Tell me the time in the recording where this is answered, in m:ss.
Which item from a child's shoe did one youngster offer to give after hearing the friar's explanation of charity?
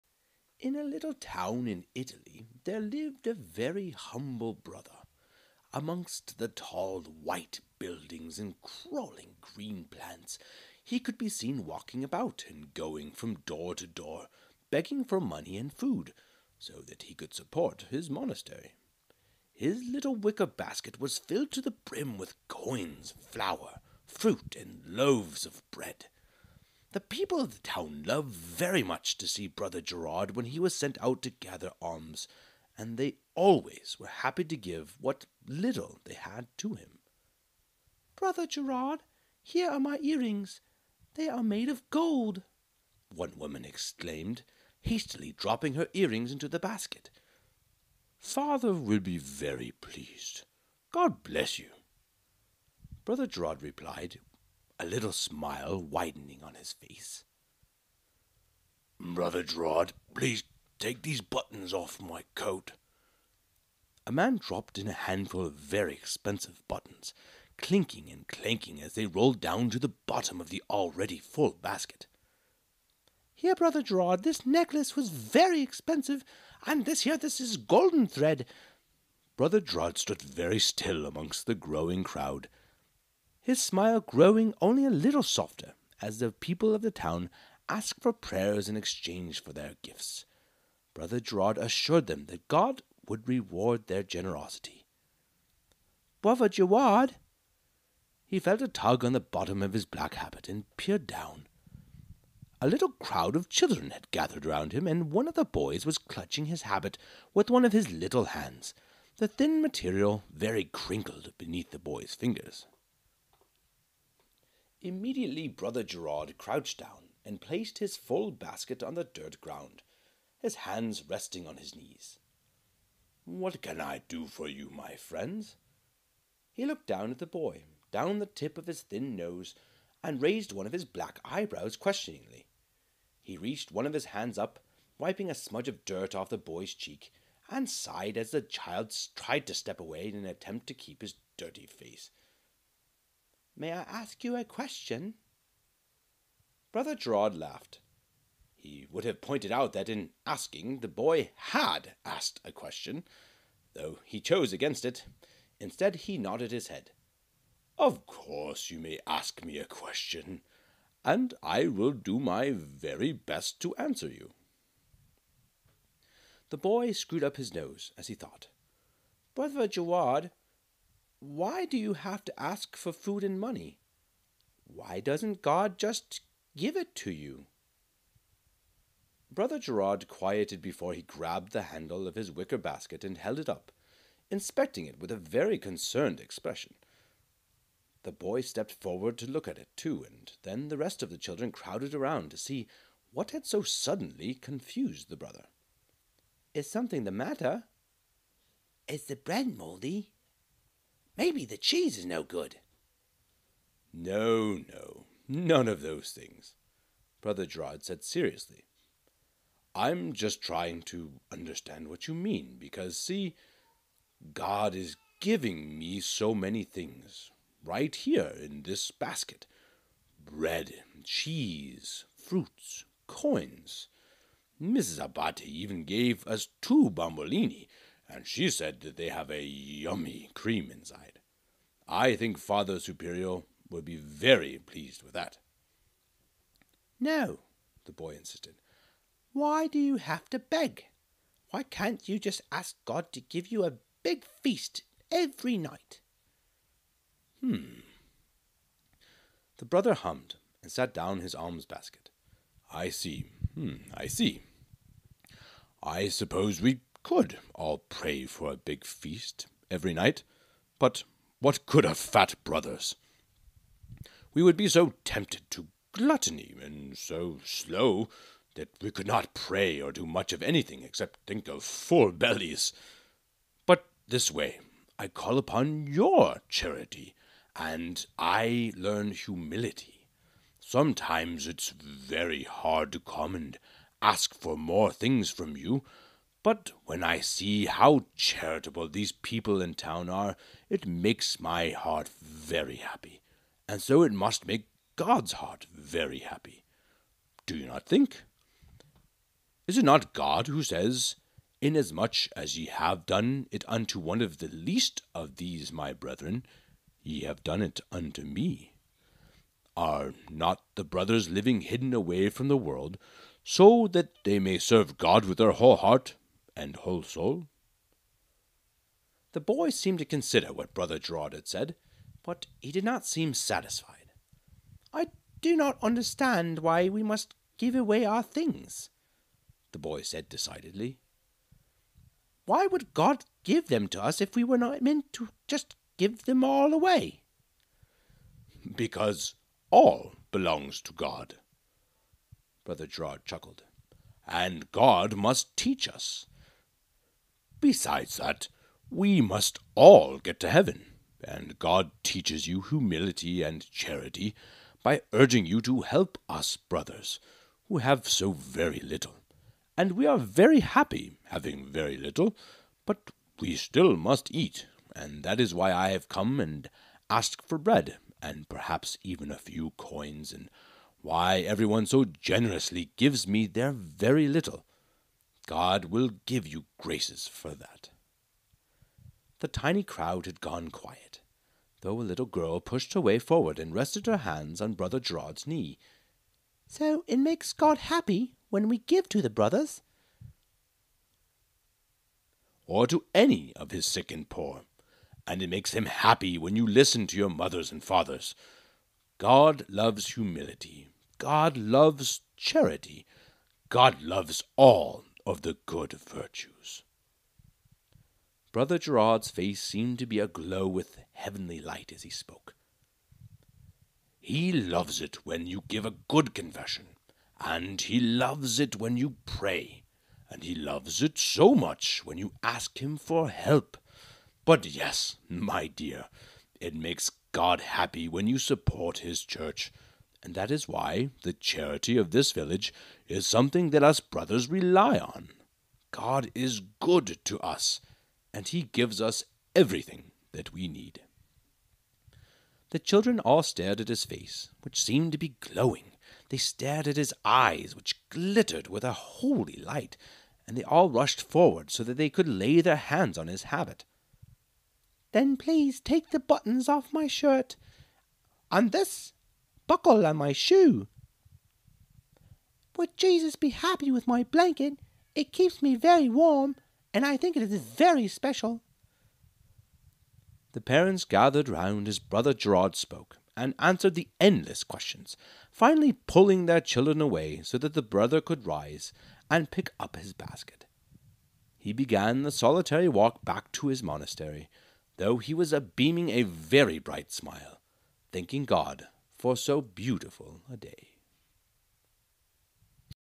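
7:39.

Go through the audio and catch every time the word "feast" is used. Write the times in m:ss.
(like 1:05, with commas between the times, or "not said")
4:04, 4:18.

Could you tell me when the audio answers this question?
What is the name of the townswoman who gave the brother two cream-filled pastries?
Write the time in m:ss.
3:44.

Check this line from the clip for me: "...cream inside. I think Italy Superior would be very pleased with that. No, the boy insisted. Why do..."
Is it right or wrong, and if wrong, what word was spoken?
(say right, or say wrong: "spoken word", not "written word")
wrong: "Father", not "Italy".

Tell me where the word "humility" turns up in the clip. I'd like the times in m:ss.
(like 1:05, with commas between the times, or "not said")
4:39, 5:52, 6:40.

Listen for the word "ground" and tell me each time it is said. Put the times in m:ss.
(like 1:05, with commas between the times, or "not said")
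1:59.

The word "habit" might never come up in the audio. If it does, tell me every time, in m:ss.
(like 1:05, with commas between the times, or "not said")
1:40, 1:46, 7:33.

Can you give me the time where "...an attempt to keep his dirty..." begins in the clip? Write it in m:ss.
2:20.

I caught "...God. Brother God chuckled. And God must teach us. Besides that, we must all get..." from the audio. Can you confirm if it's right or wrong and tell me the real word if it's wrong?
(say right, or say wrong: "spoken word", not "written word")
wrong: "Gerard", not "God".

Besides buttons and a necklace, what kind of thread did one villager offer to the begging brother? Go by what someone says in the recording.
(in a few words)
Golden thread.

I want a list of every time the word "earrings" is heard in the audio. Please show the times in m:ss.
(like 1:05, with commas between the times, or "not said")
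0:40, 0:45.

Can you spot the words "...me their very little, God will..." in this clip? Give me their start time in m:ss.
6:13.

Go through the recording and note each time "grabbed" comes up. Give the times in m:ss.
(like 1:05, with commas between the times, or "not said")
3:01.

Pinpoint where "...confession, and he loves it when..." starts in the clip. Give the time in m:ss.
6:56.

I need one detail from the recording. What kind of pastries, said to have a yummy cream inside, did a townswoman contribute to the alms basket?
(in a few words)
Bombolini.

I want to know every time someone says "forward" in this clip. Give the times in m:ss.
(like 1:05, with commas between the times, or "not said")
3:08, 6:23, 7:31.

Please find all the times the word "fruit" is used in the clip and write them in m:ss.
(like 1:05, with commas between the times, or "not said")
0:24, 3:42.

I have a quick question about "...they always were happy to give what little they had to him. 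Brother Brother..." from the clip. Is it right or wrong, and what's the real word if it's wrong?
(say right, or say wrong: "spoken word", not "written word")
wrong: "Gerard", not "Brother".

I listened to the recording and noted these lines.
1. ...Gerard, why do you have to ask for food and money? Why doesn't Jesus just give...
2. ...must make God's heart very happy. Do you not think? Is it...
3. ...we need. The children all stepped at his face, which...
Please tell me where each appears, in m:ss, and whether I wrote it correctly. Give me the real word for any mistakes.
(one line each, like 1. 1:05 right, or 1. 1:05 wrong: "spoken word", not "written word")
1. 2:49 wrong: "God", not "Jesus"
2. 4:54 right
3. 7:20 wrong: "stared", not "stepped".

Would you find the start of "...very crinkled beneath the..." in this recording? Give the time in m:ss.
1:50.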